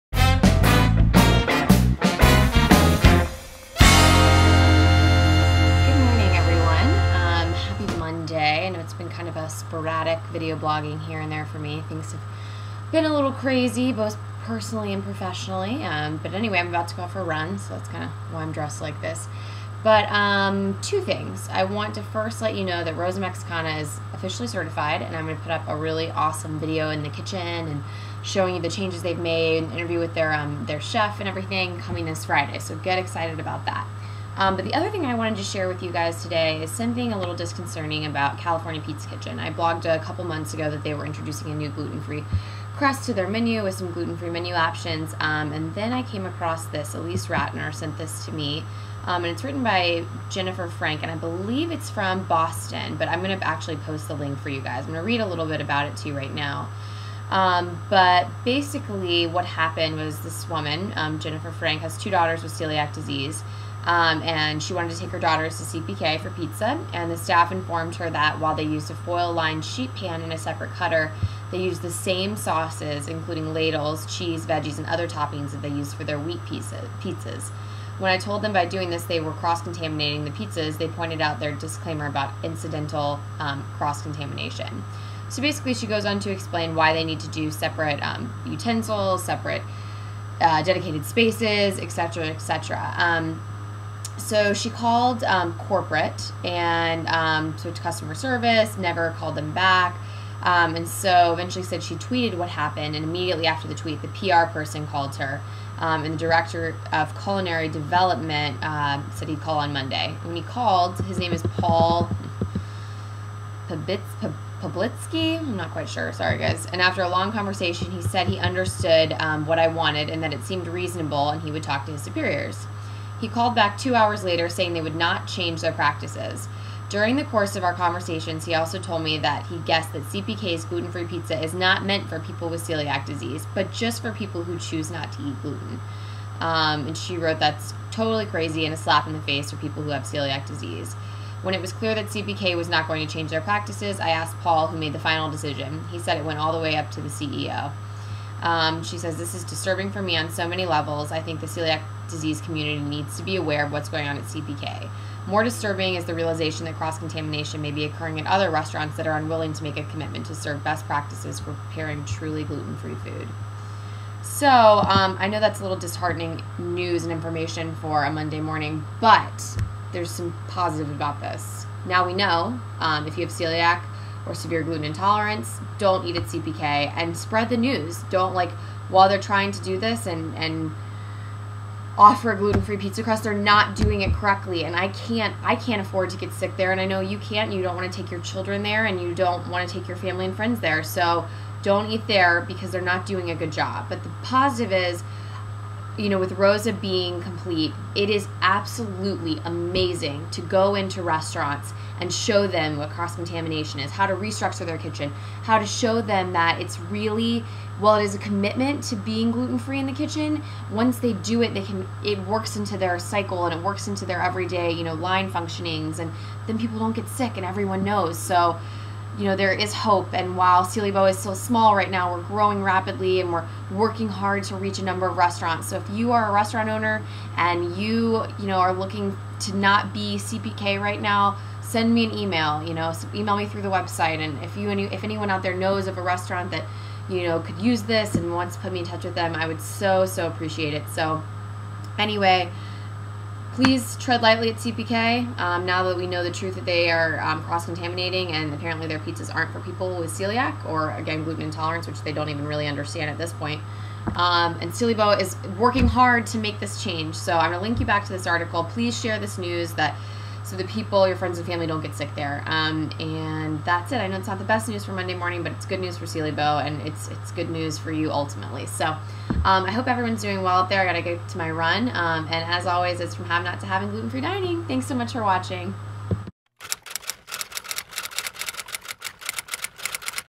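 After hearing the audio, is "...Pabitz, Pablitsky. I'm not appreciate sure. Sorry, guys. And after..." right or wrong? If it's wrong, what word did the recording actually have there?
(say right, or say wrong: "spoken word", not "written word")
wrong: "quite", not "appreciate".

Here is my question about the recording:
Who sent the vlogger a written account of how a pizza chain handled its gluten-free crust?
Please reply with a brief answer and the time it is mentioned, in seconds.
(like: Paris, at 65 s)
Elise Ratner, at 46 s.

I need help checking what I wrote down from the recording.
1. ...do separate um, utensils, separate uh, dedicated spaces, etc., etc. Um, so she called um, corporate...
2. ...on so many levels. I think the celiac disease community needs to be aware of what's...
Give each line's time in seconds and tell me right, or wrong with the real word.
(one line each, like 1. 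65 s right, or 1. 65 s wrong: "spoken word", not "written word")
1. 87 s right
2. 150 s right.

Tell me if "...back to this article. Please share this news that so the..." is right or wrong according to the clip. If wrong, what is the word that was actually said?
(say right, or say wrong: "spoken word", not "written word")
right.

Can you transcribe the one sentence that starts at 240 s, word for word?
So anyway please tread lightly at CPK.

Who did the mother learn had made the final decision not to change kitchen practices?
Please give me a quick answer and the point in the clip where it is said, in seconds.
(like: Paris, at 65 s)
The CEO, at 147 s.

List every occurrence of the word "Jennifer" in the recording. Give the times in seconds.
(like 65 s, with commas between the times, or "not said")
50 s, 61 s.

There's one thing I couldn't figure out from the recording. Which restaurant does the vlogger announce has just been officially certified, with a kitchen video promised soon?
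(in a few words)
Rosa Mexicana.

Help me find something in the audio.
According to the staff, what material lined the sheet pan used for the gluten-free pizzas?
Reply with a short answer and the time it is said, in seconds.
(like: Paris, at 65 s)
Foil, at 68 s.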